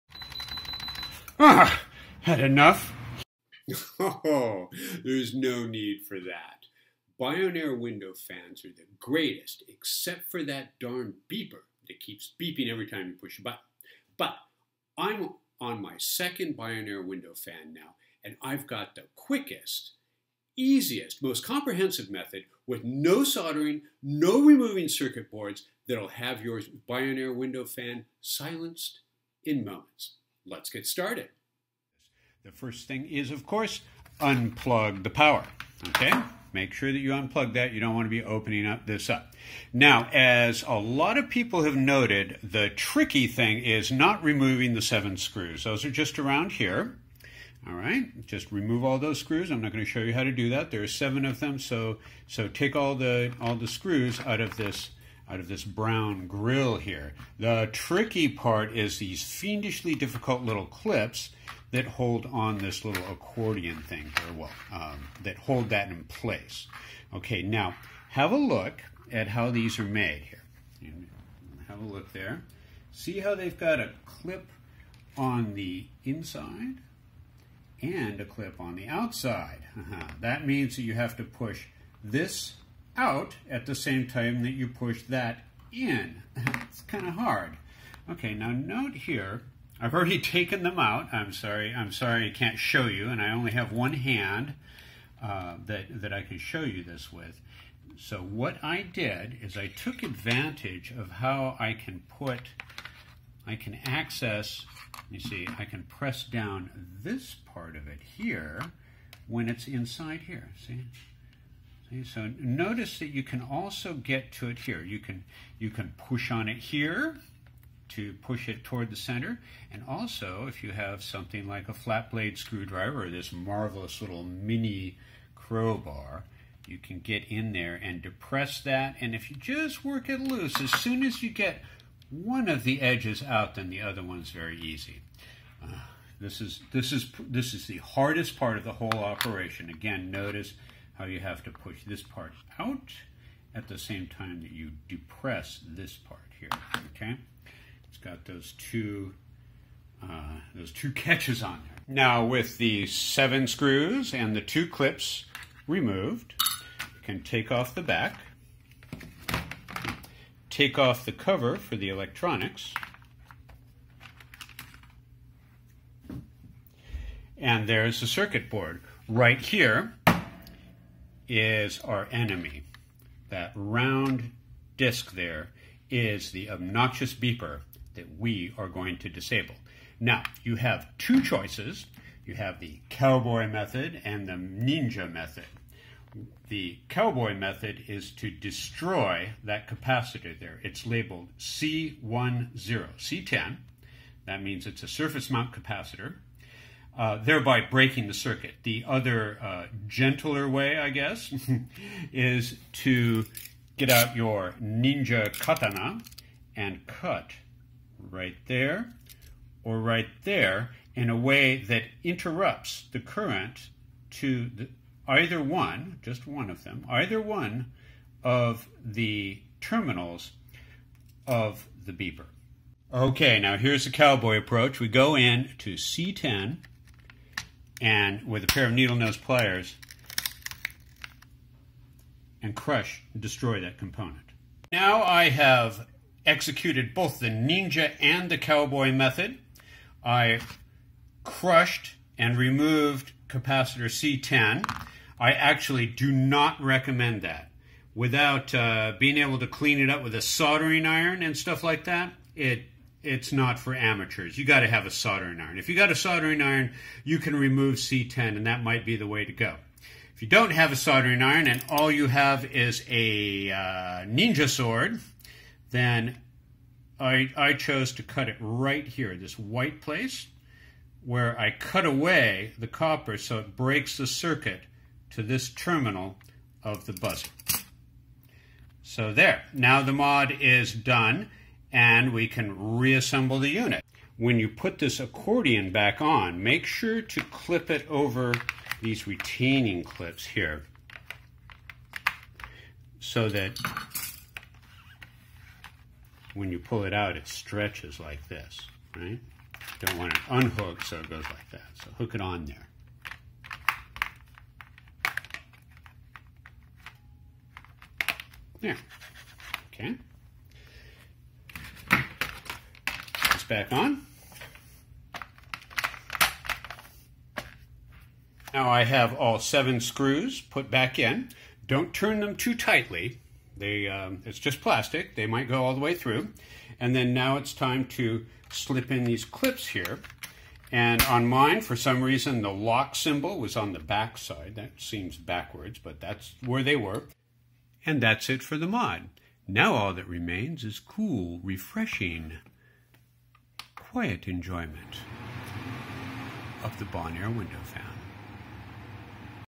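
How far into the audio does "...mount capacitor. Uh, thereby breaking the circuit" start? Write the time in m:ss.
3:15.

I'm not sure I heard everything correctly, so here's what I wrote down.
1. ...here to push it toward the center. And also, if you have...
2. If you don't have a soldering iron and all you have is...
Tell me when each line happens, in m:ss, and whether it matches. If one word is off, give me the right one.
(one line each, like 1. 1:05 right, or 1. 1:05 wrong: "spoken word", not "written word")
1. 1:56 right
2. 4:20 right.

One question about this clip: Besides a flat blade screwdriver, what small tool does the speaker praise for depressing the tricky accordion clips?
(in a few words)
Mini crowbar.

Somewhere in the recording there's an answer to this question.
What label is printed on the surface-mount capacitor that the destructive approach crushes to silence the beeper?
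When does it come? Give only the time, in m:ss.
3:10.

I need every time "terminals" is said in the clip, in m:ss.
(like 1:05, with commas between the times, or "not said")
3:39, 4:35.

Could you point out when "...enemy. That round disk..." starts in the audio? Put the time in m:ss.
2:52.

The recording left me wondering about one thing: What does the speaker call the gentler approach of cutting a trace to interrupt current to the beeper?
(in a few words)
The ninja method.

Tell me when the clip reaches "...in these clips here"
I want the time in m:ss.
5:28.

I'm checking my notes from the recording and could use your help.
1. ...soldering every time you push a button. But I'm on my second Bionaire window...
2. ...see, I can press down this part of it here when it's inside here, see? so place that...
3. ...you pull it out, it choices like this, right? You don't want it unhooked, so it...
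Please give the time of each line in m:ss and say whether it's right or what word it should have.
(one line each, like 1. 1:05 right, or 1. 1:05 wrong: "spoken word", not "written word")
1. 0:12 wrong: "beeping", not "soldering"
2. 1:45 wrong: "notice", not "place"
3. 4:56 wrong: "stretches", not "choices".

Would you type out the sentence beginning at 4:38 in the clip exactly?
So there, now the mod is done and we can reassemble the unit.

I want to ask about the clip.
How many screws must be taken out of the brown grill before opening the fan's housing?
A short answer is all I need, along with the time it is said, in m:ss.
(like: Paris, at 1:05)
7, at 0:50.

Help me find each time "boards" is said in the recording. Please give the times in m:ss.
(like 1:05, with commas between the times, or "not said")
0:25, 2:48.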